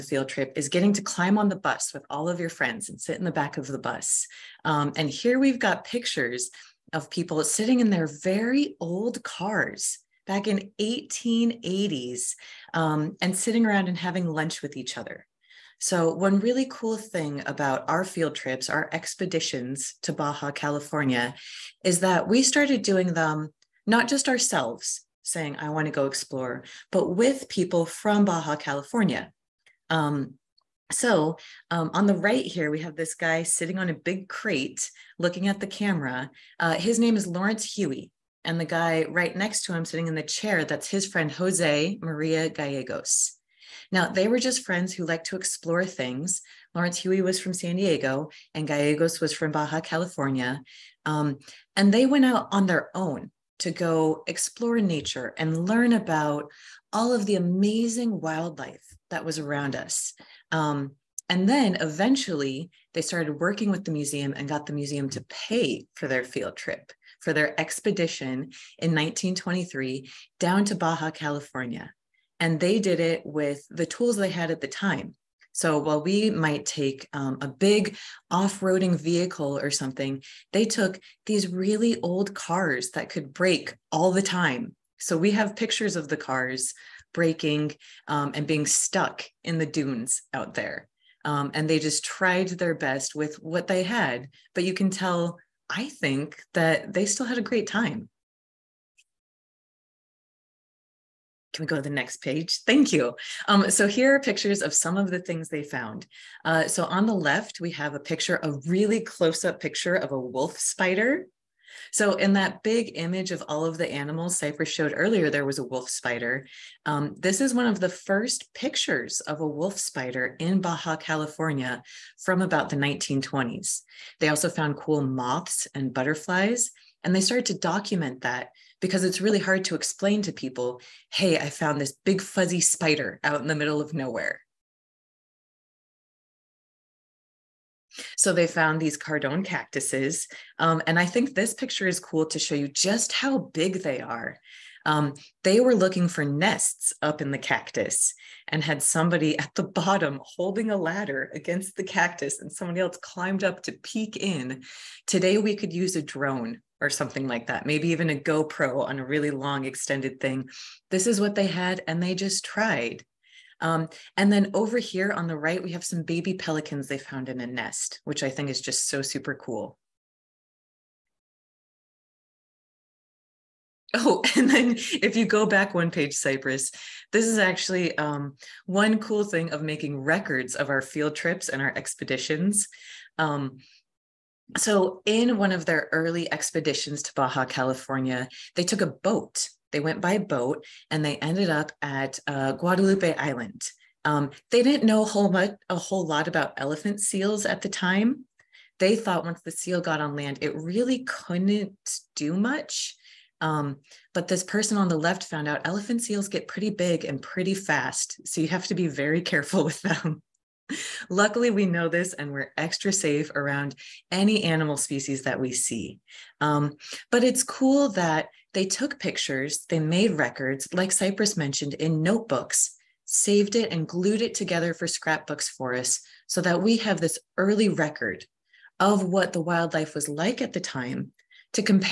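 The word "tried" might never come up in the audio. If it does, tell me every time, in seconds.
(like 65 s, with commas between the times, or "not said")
92 s, 162 s.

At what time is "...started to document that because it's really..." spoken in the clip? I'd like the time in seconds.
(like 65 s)
127 s.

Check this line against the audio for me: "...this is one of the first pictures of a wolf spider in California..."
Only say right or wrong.
wrong.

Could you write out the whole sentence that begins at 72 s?
And they did it with the tools they had at the time.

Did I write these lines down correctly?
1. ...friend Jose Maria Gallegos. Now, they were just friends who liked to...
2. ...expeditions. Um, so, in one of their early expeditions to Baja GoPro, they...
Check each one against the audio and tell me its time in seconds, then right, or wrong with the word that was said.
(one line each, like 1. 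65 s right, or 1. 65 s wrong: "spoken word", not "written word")
1. 41 s right
2. 181 s wrong: "California", not "GoPro".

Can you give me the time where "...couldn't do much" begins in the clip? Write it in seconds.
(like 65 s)
201 s.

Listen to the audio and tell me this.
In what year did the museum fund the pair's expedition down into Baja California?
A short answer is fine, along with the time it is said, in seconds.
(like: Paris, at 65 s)
1923, at 68 s.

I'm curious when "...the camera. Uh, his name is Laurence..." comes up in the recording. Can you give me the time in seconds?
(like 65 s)
35 s.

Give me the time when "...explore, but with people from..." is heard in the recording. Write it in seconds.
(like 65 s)
26 s.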